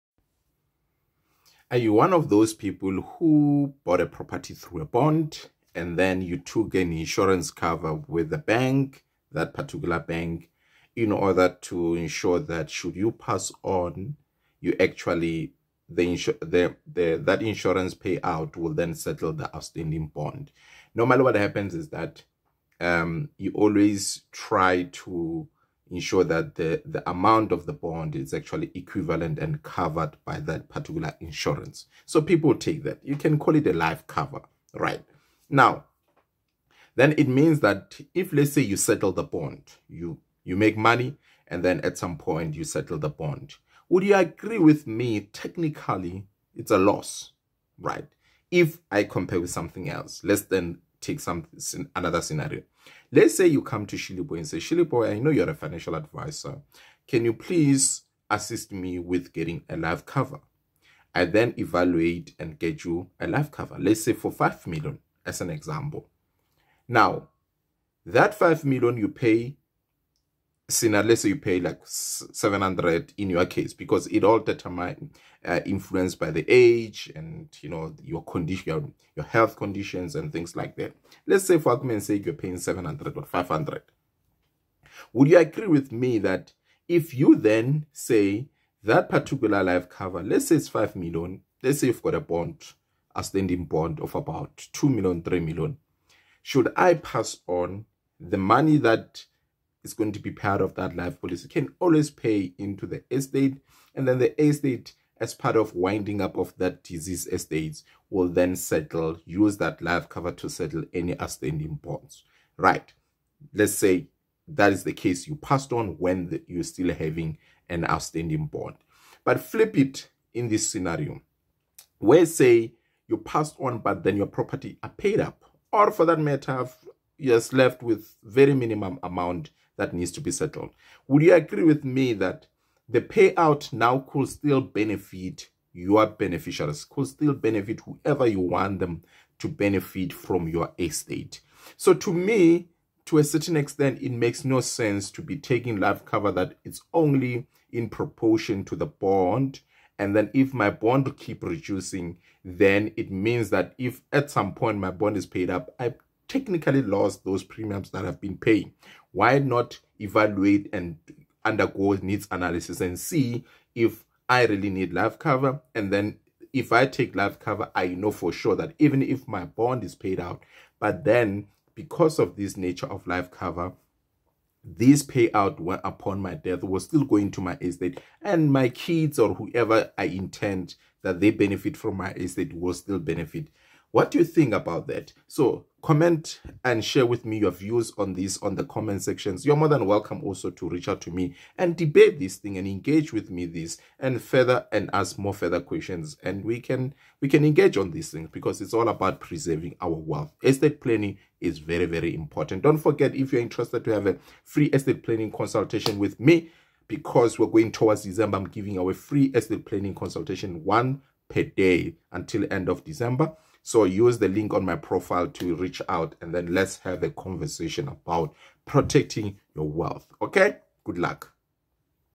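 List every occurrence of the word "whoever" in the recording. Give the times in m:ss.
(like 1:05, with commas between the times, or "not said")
2:17, 2:59.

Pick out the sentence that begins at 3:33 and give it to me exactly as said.
So use the link on my profile to reach out and then let's have a conversation about protecting your wealth.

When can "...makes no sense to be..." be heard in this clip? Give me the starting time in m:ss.
2:24.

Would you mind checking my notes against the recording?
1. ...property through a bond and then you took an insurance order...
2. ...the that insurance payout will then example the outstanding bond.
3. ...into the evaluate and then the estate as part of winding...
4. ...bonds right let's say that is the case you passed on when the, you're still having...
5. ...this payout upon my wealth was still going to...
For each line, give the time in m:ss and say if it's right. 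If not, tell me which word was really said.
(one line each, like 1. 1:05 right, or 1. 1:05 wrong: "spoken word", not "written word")
1. 0:04 wrong: "cover", not "order"
2. 0:16 wrong: "settle", not "example"
3. 1:42 wrong: "estate", not "evaluate"
4. 1:51 right
5. 2:54 wrong: "death", not "wealth".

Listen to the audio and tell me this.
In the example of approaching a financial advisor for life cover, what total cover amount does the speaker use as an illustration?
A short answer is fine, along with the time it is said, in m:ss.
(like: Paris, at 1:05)
5 million, at 1:04.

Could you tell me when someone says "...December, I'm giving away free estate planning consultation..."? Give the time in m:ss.
3:28.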